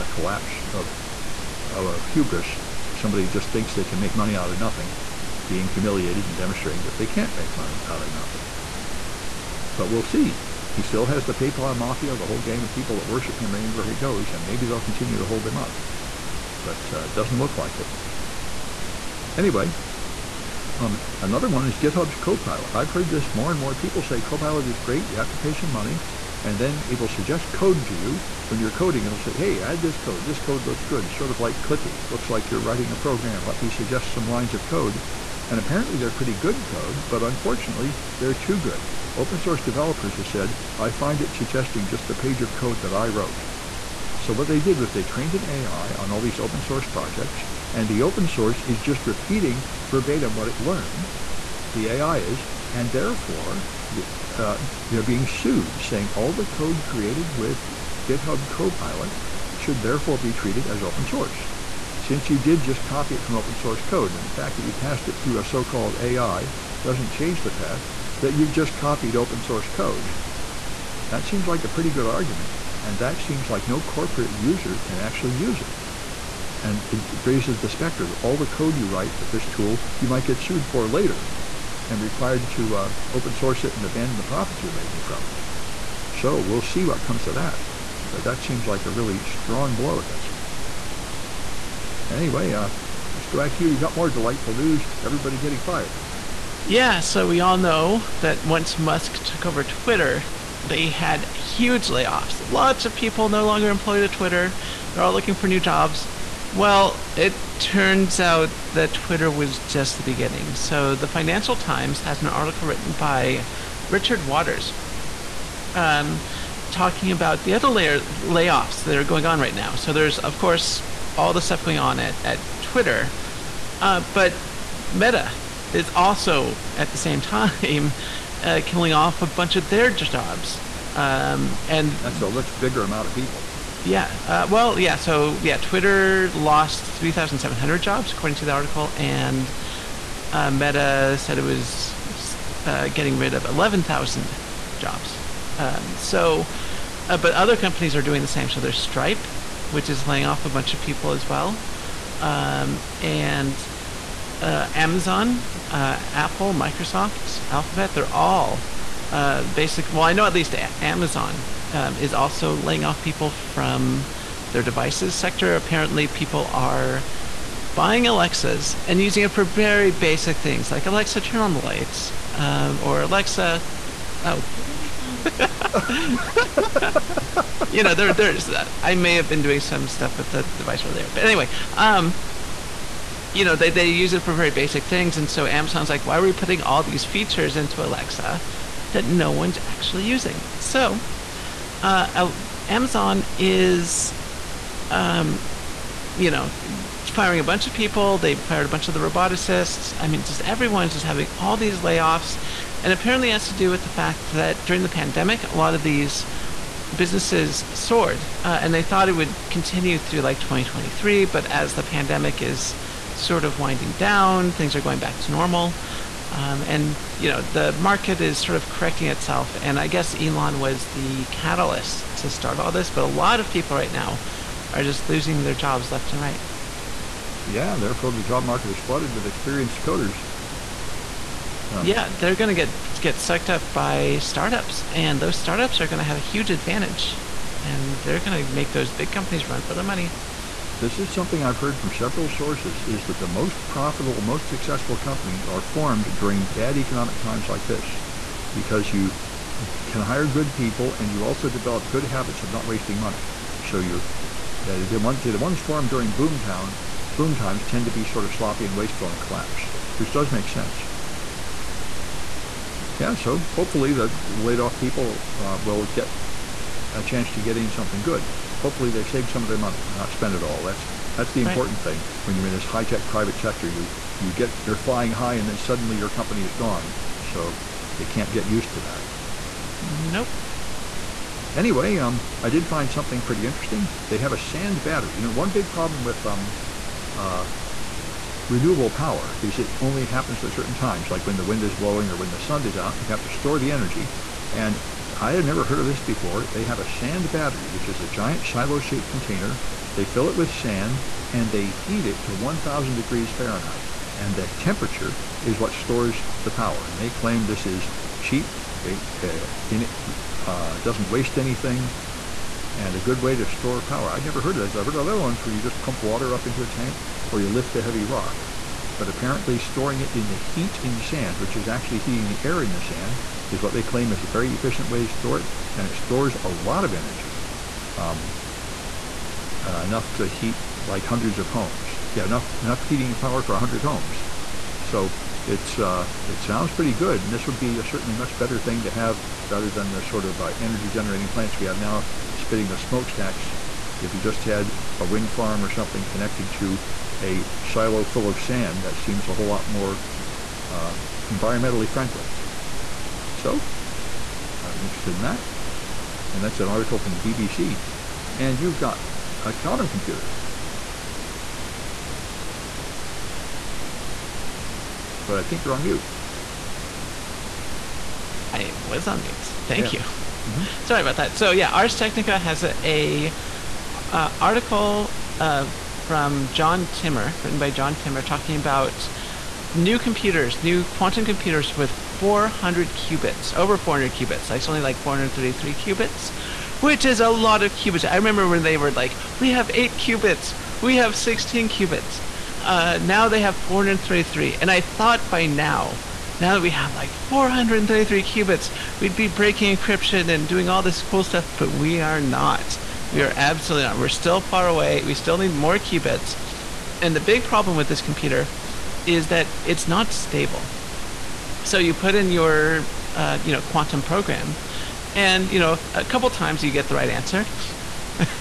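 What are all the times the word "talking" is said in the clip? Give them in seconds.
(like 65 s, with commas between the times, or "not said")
116 s, 378 s.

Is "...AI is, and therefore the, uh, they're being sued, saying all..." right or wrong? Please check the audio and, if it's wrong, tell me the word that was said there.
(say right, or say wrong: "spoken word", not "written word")
right.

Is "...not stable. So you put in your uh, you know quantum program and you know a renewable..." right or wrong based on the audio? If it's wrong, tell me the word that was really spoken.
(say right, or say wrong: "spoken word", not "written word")
wrong: "couple", not "renewable".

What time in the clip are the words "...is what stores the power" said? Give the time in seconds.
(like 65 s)
305 s.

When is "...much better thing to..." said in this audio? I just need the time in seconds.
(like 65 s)
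338 s.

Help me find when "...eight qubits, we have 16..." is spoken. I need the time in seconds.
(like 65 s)
389 s.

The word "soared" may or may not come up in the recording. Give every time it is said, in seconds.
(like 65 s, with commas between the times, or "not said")
207 s.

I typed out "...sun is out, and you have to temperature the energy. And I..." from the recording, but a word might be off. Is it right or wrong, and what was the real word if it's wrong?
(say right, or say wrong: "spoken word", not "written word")
wrong: "store", not "temperature".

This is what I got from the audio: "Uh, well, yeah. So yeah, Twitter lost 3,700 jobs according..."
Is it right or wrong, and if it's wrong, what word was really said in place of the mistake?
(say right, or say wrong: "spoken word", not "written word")
right.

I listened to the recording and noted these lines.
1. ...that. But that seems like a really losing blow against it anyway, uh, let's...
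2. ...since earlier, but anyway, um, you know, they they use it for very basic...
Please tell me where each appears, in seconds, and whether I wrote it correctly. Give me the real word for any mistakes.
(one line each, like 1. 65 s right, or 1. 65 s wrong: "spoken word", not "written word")
1. 87 s wrong: "strong", not "losing"
2. 180 s wrong: "device", not "since".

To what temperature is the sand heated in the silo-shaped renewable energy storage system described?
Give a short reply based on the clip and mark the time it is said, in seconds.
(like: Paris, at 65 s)
1,000 degrees Fahrenheit, at 302 s.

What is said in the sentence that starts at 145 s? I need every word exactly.
Um, so, uh, but other companies are doing the same.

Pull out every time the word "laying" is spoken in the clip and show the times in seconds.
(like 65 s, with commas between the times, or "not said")
150 s, 162 s.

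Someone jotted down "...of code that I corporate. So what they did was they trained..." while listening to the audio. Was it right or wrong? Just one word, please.
wrong.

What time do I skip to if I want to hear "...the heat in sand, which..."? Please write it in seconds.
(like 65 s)
320 s.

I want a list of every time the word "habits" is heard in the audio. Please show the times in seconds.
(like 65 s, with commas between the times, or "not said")
252 s.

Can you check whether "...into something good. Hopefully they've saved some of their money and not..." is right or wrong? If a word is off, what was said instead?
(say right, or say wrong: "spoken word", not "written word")
right.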